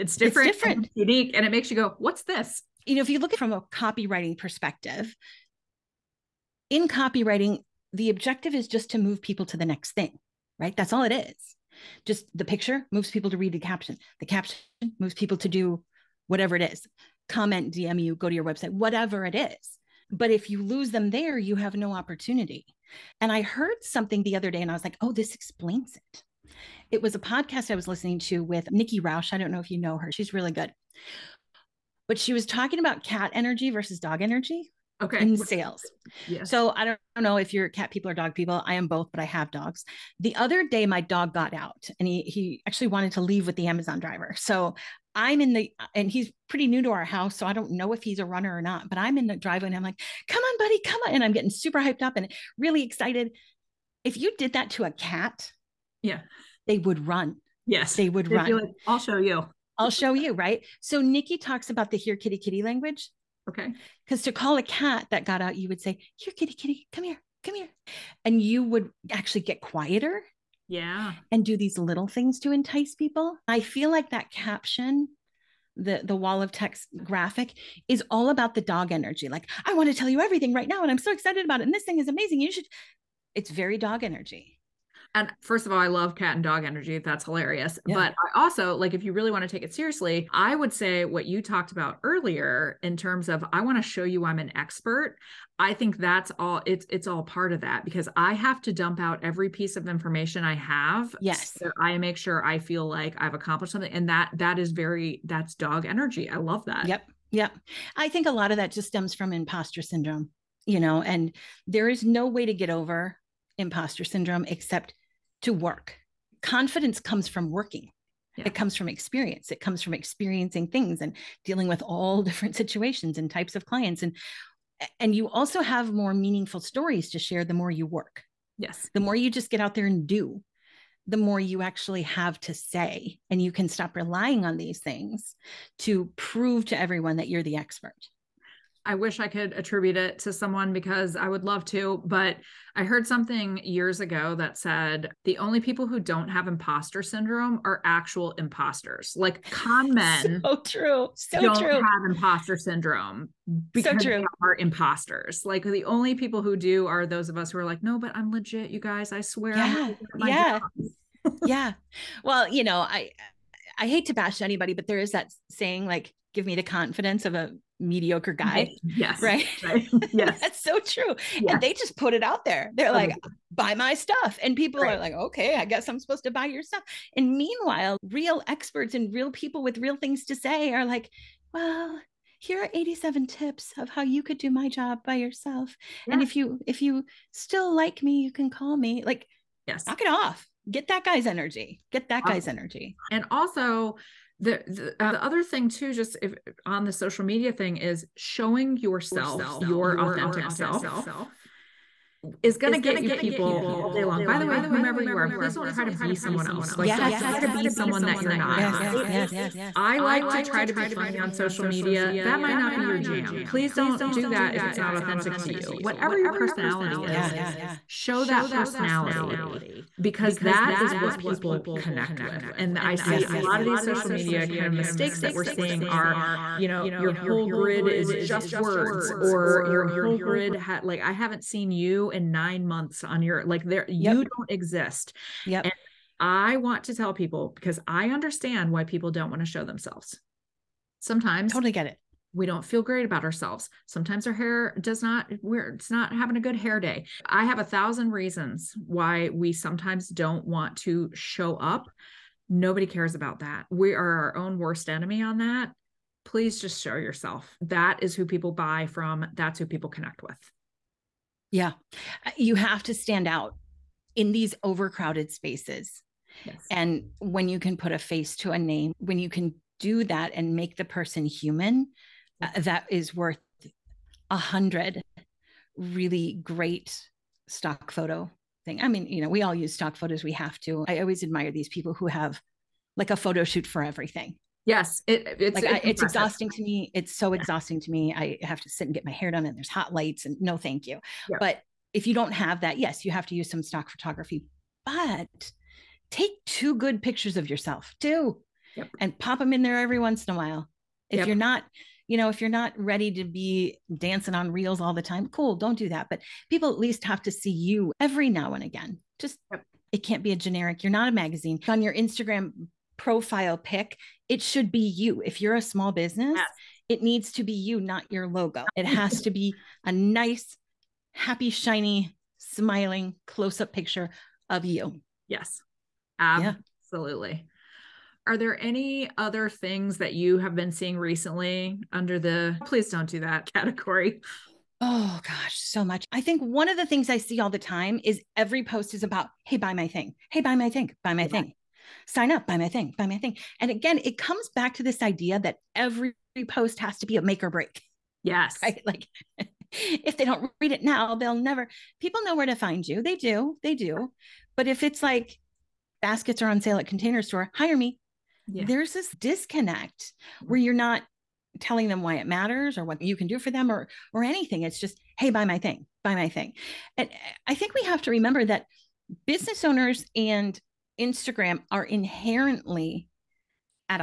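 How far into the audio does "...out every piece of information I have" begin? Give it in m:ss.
1:38.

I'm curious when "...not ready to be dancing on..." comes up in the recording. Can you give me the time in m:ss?
5:02.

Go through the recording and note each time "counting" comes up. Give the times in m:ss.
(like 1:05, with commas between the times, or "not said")
not said.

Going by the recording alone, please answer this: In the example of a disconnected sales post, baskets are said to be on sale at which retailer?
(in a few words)
Container Store.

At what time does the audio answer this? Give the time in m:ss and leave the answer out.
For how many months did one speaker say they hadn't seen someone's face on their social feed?
3:52.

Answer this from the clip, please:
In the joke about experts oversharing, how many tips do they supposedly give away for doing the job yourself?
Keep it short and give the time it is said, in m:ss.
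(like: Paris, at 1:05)
87, at 3:02.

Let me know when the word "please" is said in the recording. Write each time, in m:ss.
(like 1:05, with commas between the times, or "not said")
3:25, 3:33, 4:16, 5:32.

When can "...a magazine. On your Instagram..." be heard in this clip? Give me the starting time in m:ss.
5:11.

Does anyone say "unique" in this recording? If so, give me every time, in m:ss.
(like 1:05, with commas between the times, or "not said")
0:00.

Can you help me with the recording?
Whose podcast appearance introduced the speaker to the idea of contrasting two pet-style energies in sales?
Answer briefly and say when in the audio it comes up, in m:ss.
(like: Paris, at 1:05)
Nikki Rausch, at 0:28.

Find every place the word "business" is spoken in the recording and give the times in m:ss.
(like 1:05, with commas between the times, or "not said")
5:15, 6:09.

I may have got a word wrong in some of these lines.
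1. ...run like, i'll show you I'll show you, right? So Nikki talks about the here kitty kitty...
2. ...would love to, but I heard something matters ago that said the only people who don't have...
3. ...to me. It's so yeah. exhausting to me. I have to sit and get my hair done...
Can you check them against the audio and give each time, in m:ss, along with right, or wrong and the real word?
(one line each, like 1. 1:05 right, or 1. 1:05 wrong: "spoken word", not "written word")
1. 0:58 right
2. 2:21 wrong: "years", not "matters"
3. 4:46 right.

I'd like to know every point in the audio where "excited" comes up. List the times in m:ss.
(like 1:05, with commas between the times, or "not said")
0:52, 1:21.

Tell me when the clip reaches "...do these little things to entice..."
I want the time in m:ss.
1:11.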